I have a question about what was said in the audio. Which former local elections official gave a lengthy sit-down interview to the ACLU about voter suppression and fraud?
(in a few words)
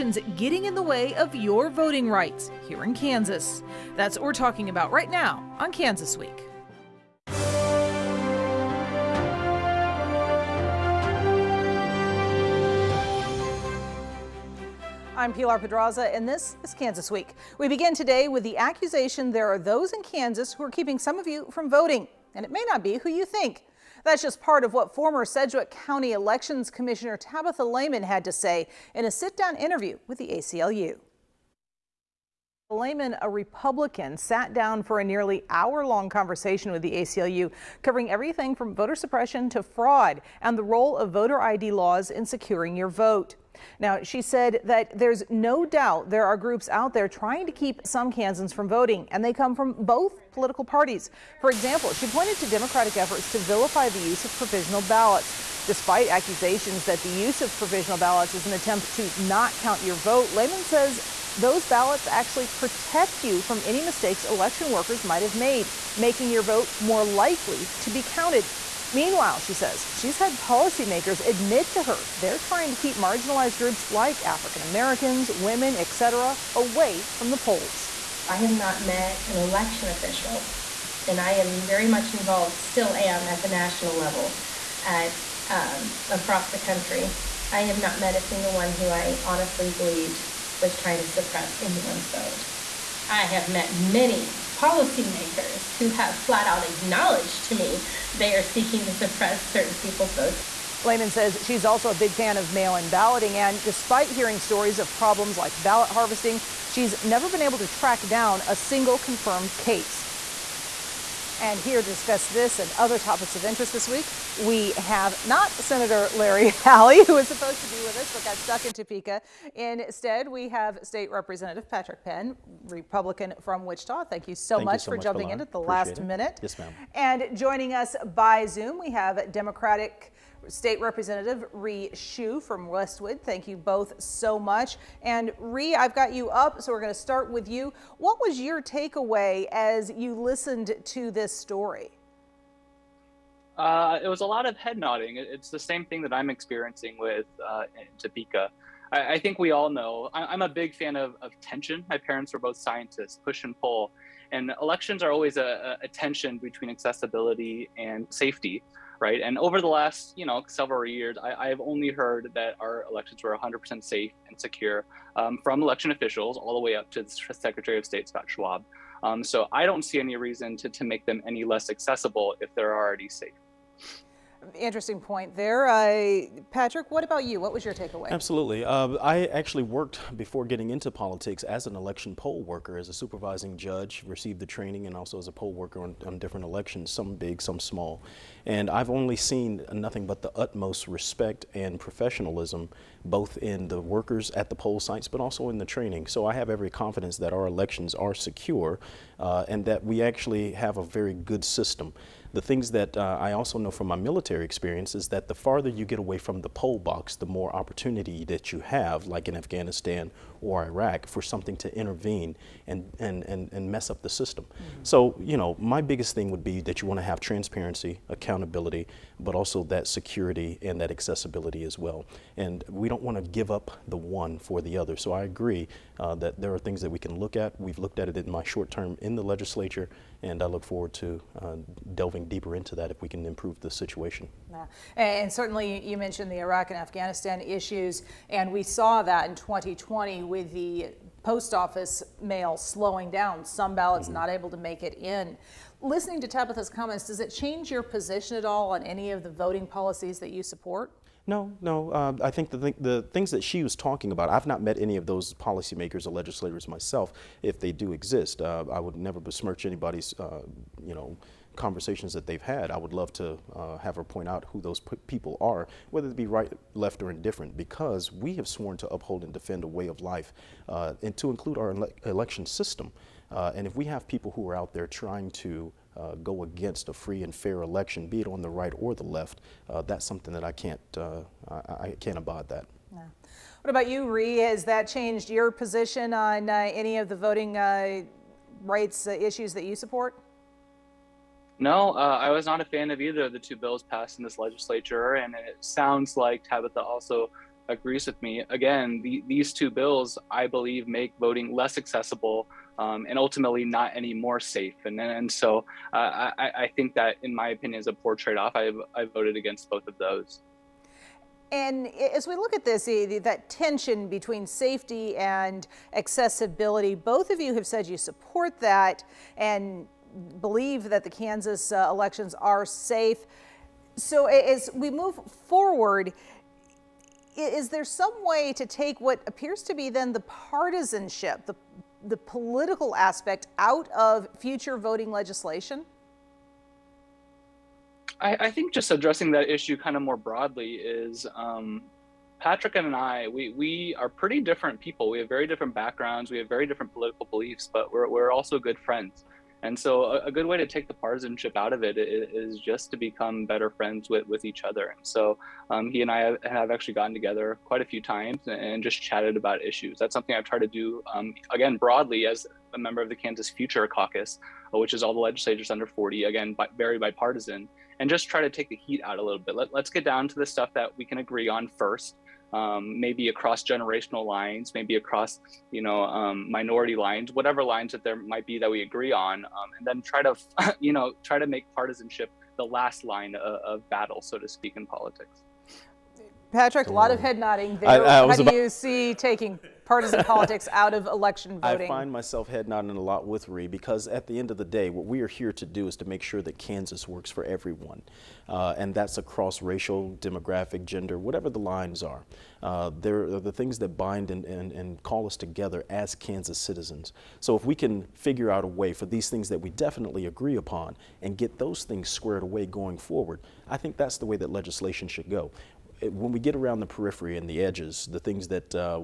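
Tabitha Lehman.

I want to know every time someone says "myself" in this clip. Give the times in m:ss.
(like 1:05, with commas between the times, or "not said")
4:16, 6:32.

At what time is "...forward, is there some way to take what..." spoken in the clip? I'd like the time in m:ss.
5:25.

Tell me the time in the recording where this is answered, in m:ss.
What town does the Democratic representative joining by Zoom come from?
2:12.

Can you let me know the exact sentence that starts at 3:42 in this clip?
And we don't want to give up the one for the other.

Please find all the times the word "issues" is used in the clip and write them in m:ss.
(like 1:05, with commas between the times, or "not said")
3:57, 4:49, 5:39, 5:59.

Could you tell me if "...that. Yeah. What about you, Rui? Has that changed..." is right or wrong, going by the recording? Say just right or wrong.
right.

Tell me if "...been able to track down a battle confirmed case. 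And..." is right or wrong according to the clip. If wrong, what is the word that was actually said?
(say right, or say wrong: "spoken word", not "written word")
wrong: "single", not "battle".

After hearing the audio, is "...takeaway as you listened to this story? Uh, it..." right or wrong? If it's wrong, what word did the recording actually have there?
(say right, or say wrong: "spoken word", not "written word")
right.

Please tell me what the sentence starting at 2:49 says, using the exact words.
Um, so I don't see any reason to, to make them any less accessible if they're already safe.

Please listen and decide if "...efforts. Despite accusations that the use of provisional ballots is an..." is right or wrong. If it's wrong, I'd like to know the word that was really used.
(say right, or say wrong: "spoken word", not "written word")
wrong: "ballots", not "efforts".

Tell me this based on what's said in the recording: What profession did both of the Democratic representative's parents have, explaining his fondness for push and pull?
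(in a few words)
scientists.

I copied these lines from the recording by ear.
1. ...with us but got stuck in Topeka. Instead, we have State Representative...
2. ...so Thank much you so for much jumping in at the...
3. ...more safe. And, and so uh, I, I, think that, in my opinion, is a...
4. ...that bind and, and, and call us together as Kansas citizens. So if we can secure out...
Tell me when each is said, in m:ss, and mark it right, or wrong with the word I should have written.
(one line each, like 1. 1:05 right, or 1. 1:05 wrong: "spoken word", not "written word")
1. 1:57 right
2. 2:04 right
3. 5:04 right
4. 6:43 wrong: "figure", not "secure".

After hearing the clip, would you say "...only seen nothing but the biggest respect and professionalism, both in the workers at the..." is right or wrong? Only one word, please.
wrong.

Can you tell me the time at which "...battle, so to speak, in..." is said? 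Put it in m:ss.
6:23.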